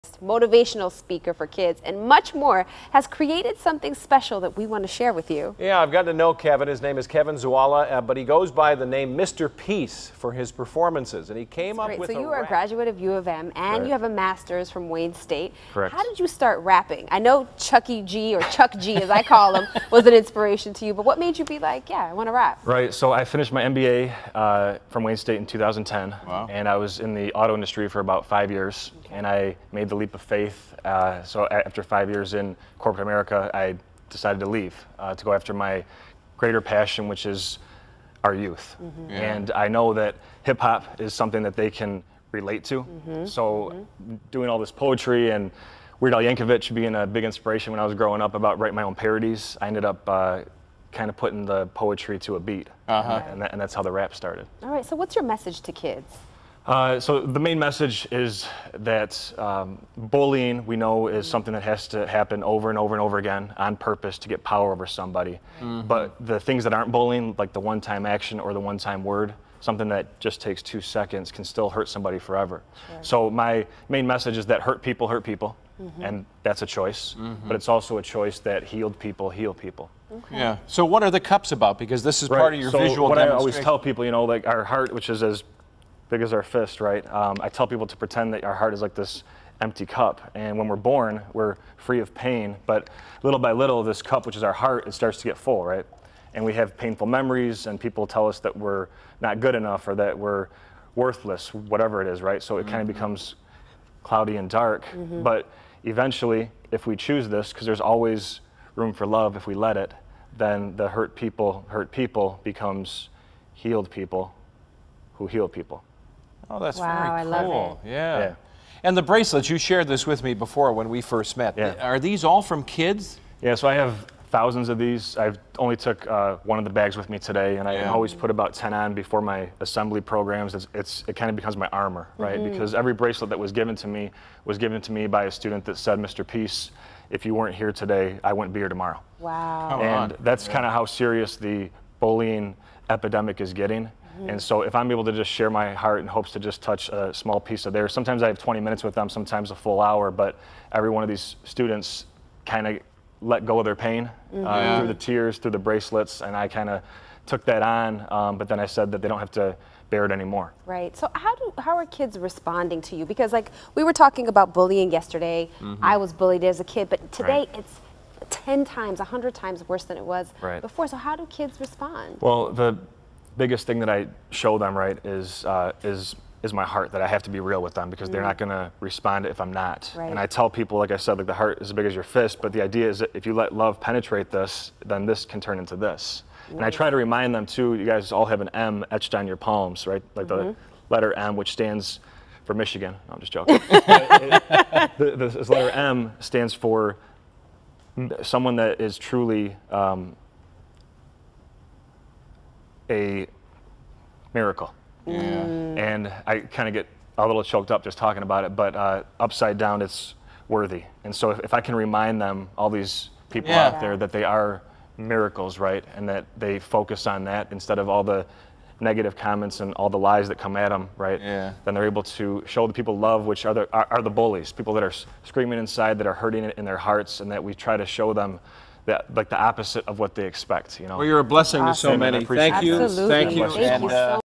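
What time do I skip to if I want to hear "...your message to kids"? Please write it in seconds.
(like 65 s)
55 s.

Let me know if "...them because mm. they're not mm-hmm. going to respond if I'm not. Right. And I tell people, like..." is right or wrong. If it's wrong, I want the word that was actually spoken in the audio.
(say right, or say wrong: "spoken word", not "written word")
right.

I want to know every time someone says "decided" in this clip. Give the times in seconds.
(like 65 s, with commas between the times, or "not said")
34 s.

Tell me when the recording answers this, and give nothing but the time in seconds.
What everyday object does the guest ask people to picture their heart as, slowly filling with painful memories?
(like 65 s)
89 s.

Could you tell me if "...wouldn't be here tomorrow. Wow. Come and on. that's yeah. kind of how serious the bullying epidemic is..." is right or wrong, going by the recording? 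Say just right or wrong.
right.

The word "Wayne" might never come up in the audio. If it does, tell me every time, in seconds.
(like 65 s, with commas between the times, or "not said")
14 s, 25 s.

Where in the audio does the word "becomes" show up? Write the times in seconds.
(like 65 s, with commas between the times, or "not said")
102 s, 112 s, 131 s.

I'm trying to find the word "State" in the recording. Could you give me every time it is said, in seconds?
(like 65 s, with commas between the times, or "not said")
15 s, 25 s.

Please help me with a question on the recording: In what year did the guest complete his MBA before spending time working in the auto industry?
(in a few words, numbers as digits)
2010.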